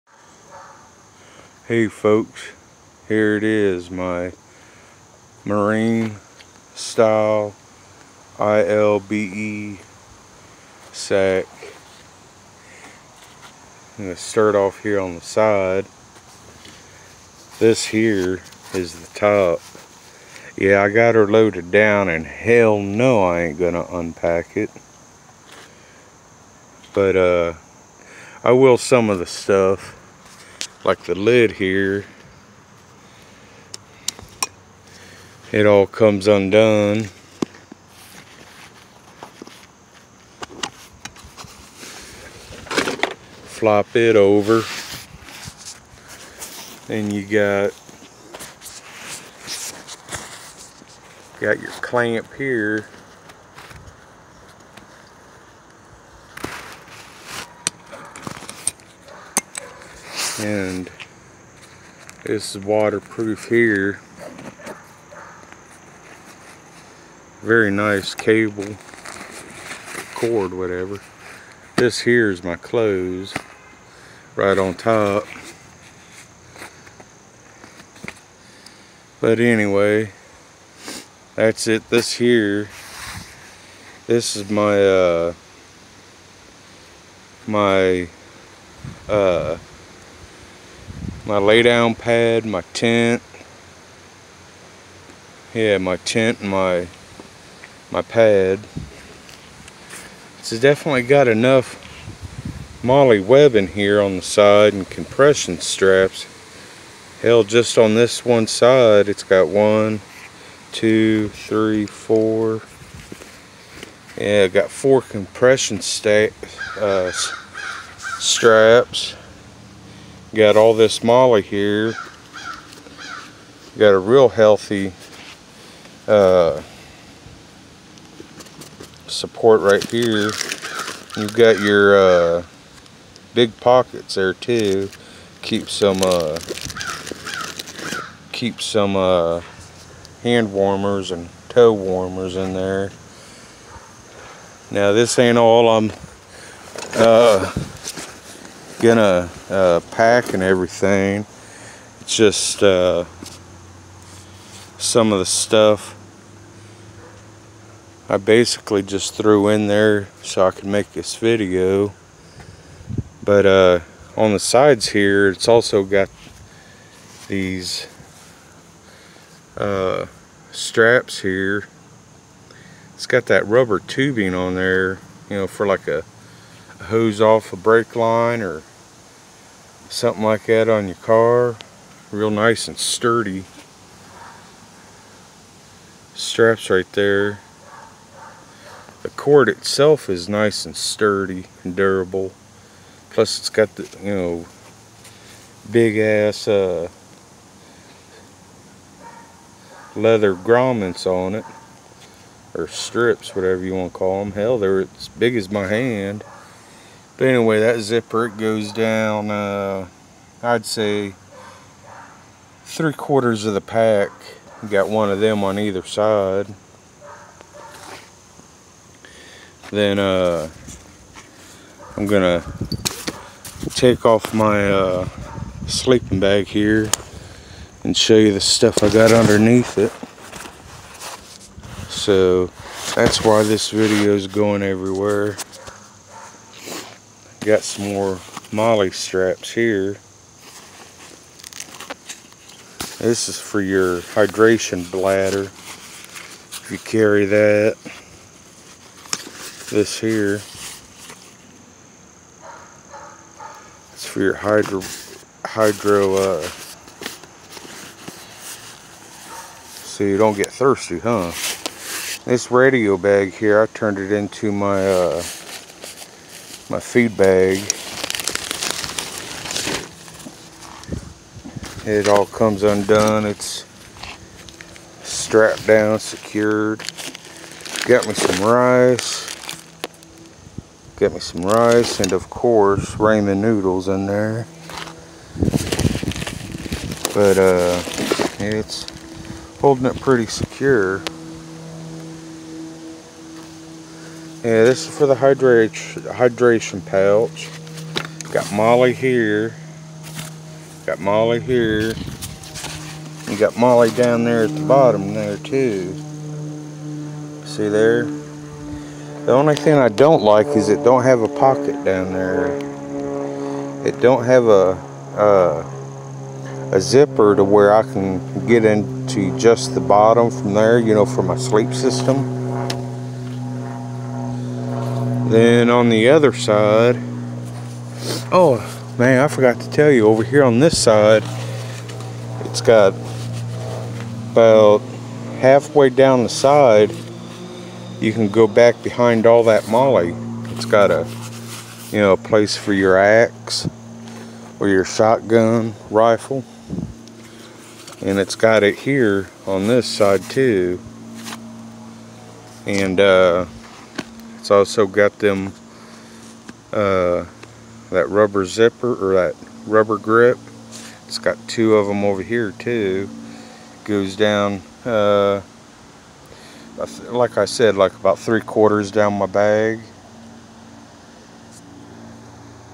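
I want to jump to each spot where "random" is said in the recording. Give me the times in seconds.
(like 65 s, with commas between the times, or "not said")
not said.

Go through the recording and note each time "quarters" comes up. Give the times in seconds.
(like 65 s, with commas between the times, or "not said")
212 s, 368 s.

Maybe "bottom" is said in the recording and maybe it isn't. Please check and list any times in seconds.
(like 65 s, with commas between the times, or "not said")
304 s, 319 s.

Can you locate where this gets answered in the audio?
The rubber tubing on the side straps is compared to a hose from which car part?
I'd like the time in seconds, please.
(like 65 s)
177 s.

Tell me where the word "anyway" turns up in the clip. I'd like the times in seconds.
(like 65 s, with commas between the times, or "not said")
79 s, 207 s.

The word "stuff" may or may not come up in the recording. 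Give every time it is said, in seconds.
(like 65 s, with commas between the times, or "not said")
29 s, 155 s, 228 s.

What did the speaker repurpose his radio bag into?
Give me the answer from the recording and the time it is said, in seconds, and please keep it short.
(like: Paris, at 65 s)
food bag, at 266 s.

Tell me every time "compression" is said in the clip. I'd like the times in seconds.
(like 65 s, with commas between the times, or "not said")
104 s, 115 s.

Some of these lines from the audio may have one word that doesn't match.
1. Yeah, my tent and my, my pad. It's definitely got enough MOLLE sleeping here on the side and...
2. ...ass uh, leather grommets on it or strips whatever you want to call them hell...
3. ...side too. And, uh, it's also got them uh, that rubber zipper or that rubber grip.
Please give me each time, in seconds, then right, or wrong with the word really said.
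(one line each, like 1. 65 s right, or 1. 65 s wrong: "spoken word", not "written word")
1. 95 s wrong: "webbing", not "sleeping"
2. 195 s right
3. 349 s right.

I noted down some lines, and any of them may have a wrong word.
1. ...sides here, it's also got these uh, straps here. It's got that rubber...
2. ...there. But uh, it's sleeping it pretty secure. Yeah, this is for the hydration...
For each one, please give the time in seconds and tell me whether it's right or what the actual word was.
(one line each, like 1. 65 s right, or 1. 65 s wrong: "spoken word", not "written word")
1. 164 s right
2. 284 s wrong: "holding", not "sleeping".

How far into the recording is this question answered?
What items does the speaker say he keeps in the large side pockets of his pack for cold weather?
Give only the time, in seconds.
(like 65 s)
140 s.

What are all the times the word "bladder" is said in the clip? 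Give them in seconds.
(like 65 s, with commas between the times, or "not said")
244 s.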